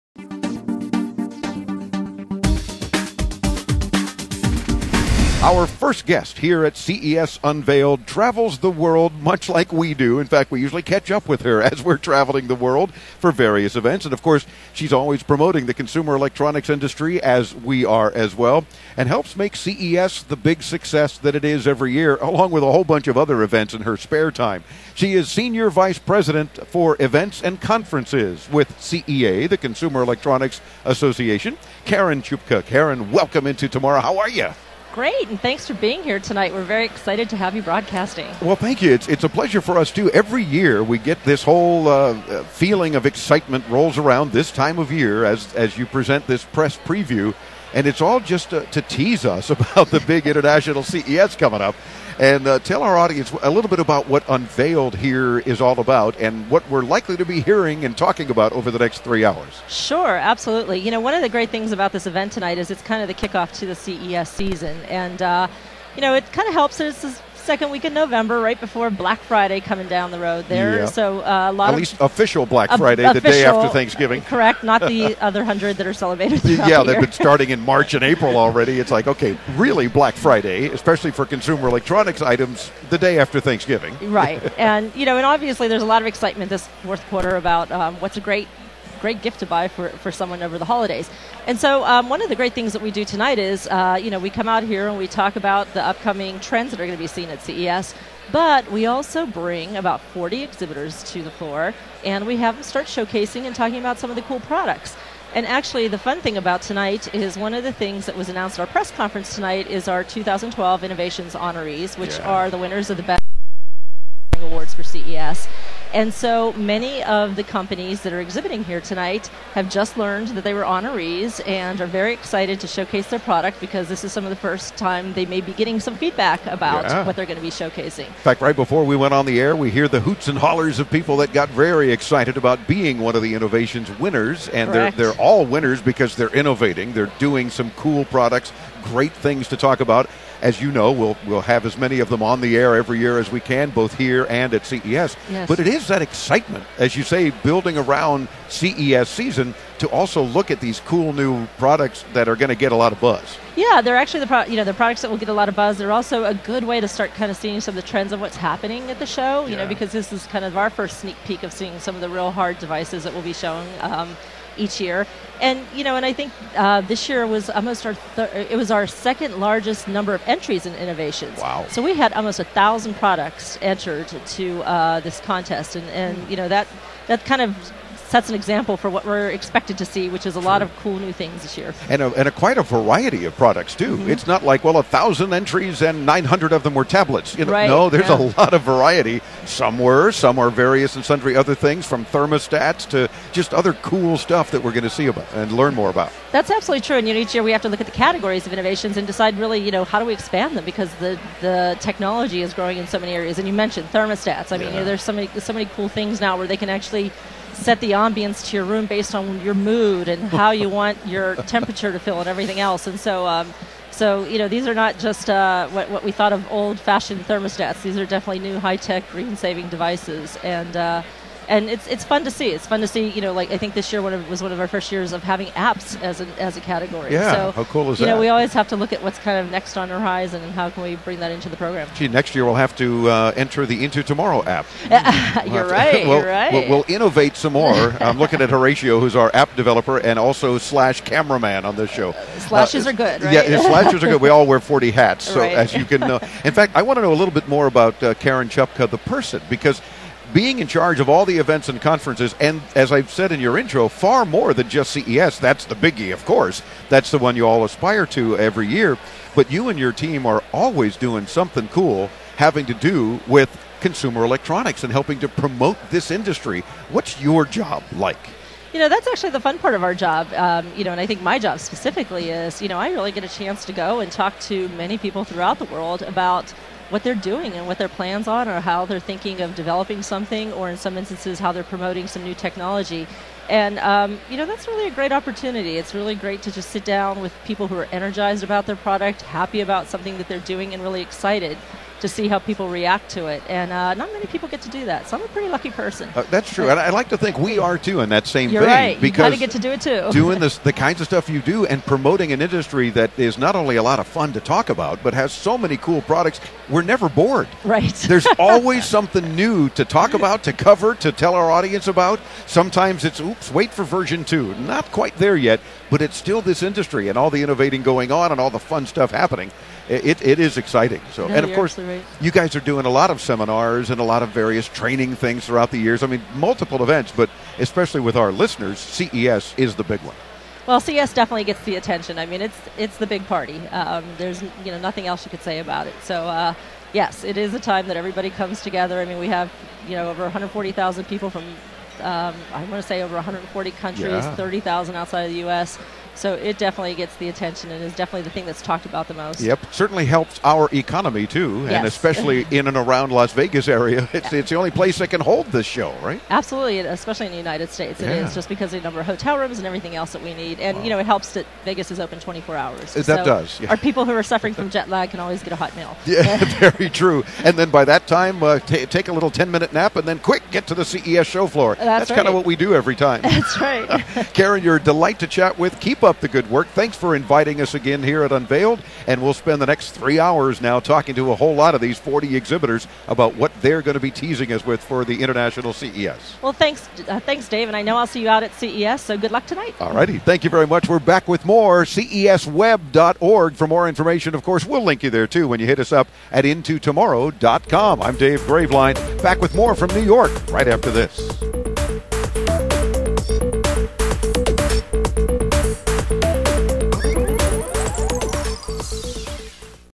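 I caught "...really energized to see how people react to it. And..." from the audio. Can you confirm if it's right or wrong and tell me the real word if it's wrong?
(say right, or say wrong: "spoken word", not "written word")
wrong: "excited", not "energized".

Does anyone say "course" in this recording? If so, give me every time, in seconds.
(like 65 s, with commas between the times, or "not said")
14 s, 256 s, 321 s, 394 s.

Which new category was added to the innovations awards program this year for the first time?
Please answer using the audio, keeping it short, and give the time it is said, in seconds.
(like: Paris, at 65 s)
apps, at 225 s.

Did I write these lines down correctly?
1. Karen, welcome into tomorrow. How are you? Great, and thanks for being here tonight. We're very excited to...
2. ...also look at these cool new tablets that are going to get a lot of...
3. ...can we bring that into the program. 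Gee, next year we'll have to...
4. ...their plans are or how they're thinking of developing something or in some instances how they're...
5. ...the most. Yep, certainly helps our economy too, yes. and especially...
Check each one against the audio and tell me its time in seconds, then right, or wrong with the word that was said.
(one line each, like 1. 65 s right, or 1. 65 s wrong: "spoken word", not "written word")
1. 32 s right
2. 149 s wrong: "products", not "tablets"
3. 230 s right
4. 277 s right
5. 349 s right.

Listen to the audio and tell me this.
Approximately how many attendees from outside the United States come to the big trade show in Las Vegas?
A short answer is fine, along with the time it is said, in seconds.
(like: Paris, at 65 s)
30,000, at 344 s.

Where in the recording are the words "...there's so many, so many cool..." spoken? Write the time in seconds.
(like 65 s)
204 s.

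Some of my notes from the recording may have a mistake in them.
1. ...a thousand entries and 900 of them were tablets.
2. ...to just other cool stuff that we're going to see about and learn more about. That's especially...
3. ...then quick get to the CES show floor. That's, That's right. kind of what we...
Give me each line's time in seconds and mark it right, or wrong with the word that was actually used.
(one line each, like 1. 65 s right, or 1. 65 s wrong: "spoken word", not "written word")
1. 184 s right
2. 192 s wrong: "absolutely", not "especially"
3. 370 s right.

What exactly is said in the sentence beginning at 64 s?
And, uh, you know, it kind of helps us second week in November, right before Black Friday coming down the road there.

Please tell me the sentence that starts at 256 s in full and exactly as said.
That's the one you all aspire to every year.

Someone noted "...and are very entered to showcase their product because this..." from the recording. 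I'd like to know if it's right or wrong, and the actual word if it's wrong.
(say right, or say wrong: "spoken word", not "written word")
wrong: "excited", not "entered".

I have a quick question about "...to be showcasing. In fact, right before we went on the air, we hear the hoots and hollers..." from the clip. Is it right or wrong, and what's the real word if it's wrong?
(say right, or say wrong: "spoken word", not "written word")
right.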